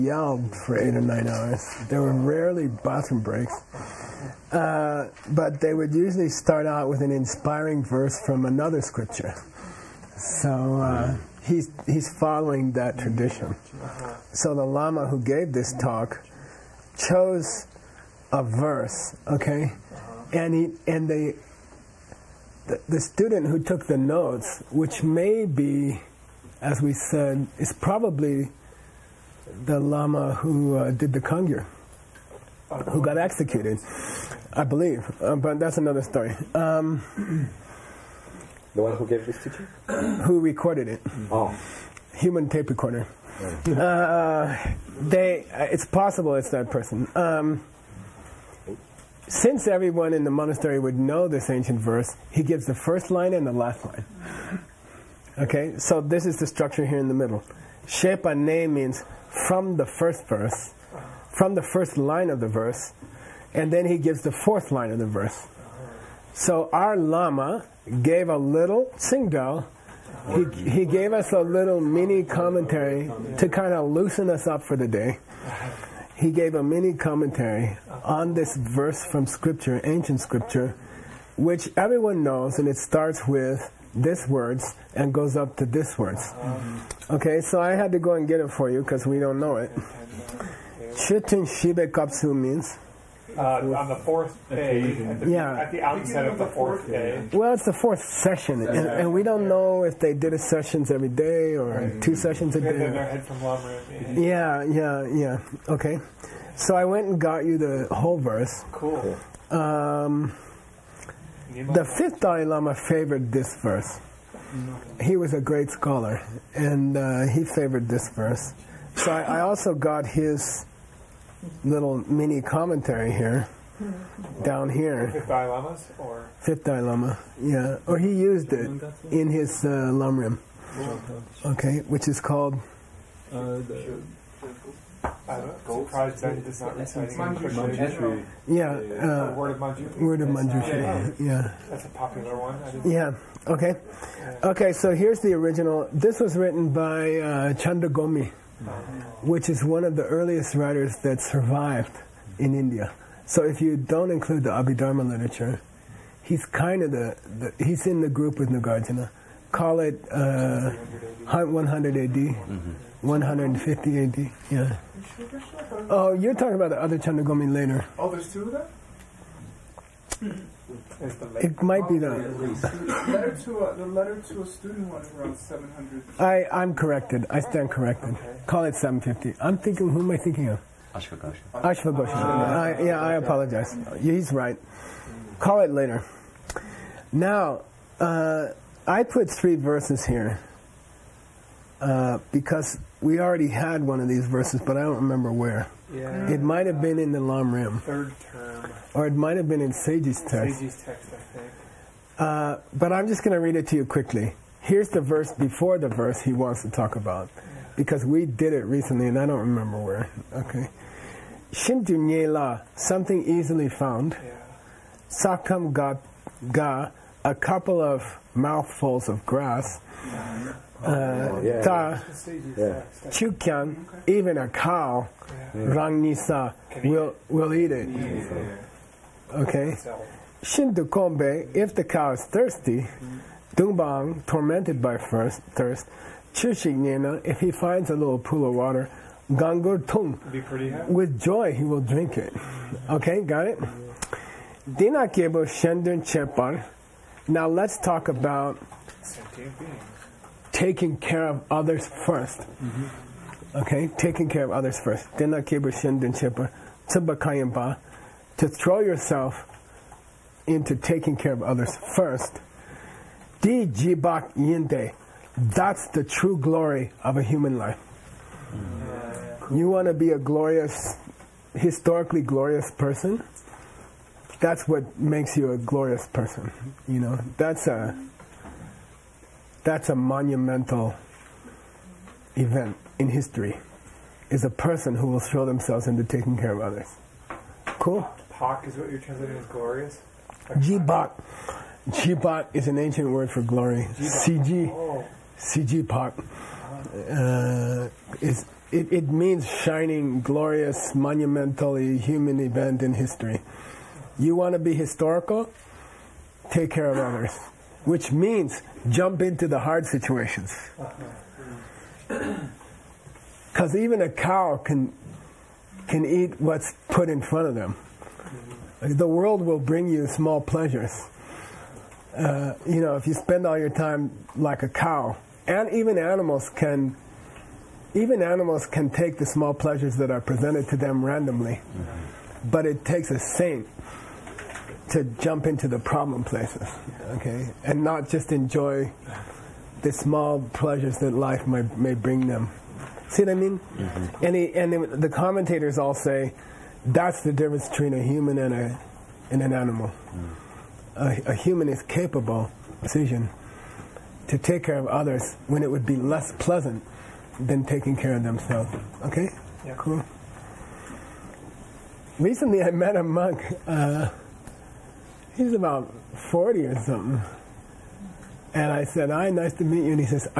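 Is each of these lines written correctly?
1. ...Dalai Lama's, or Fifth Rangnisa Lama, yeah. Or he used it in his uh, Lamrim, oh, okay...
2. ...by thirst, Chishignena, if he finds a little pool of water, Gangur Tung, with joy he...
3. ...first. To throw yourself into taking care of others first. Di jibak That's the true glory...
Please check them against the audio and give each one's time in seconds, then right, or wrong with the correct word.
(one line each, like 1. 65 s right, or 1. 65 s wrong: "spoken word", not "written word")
1. 125 s wrong: "Dalai", not "Rangnisa"
2. 234 s right
3. 254 s right.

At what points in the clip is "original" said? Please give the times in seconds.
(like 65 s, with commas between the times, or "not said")
145 s.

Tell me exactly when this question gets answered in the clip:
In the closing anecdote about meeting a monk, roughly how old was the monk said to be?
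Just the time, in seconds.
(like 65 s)
365 s.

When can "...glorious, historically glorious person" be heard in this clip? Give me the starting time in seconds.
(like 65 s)
270 s.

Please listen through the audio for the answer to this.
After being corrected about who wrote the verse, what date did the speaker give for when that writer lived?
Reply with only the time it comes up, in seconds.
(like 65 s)
178 s.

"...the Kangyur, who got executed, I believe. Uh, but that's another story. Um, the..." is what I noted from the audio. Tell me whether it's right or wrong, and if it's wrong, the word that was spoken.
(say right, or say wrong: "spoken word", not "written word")
right.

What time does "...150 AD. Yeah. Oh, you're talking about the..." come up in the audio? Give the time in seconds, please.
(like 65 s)
163 s.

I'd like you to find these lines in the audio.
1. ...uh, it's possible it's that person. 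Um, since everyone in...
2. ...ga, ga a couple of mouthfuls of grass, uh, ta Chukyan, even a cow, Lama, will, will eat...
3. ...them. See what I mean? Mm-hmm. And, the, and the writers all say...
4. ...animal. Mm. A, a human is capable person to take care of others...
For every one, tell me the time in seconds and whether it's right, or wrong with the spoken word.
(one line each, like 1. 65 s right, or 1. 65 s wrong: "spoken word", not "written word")
1. 45 s right
2. 215 s wrong: "Rangnisa", not "Lama"
3. 342 s wrong: "commentators", not "writers"
4. 349 s wrong: "decision", not "person".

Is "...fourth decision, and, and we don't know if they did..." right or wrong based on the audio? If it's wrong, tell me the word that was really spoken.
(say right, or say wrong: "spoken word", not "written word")
wrong: "session", not "decision".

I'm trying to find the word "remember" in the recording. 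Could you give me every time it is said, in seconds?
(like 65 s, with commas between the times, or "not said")
194 s, 209 s.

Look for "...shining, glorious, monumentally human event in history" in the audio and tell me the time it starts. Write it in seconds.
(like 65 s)
299 s.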